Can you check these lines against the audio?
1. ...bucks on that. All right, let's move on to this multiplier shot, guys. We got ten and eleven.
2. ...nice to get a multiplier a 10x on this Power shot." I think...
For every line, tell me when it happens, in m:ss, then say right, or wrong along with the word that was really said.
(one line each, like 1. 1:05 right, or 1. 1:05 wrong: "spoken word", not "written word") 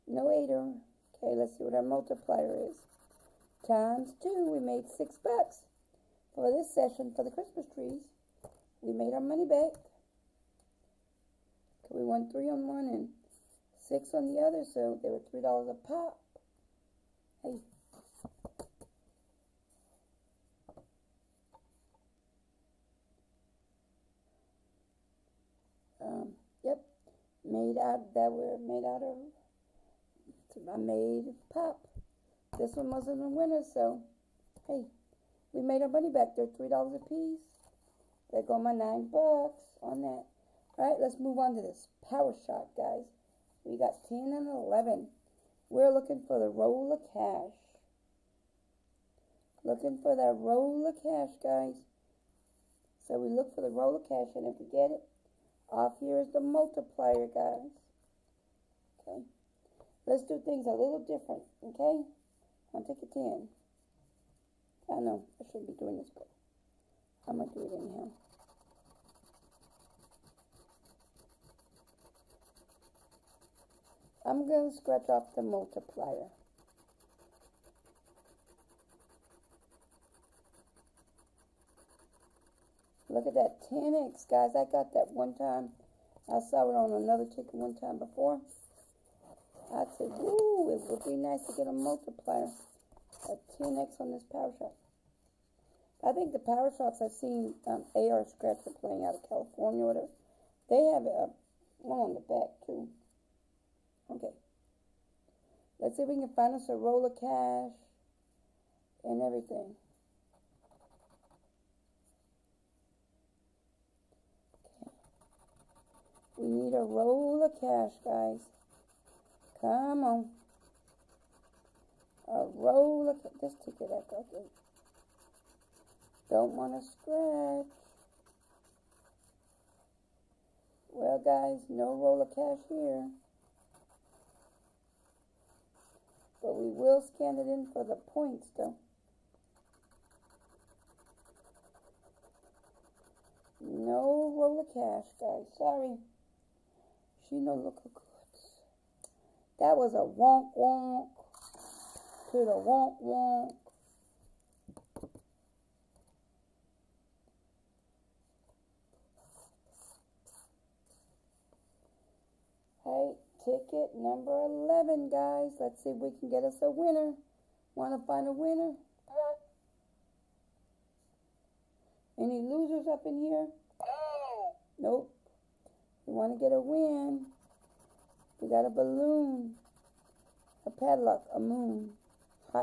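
1. 0:39 wrong: "power", not "multiplier"
2. 1:31 right.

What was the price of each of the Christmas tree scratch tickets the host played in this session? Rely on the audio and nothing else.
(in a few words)
$3.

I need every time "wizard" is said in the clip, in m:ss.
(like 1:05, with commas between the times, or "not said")
not said.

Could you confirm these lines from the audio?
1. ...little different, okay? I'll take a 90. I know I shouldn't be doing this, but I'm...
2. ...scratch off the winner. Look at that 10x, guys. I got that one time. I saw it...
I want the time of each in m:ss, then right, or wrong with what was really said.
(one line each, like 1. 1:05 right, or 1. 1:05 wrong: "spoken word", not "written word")
1. 1:00 wrong: "10", not "90"
2. 1:14 wrong: "multiplier", not "winner".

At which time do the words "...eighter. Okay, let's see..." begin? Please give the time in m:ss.
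0:00.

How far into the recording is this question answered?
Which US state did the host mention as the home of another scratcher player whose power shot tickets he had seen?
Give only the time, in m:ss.
1:39.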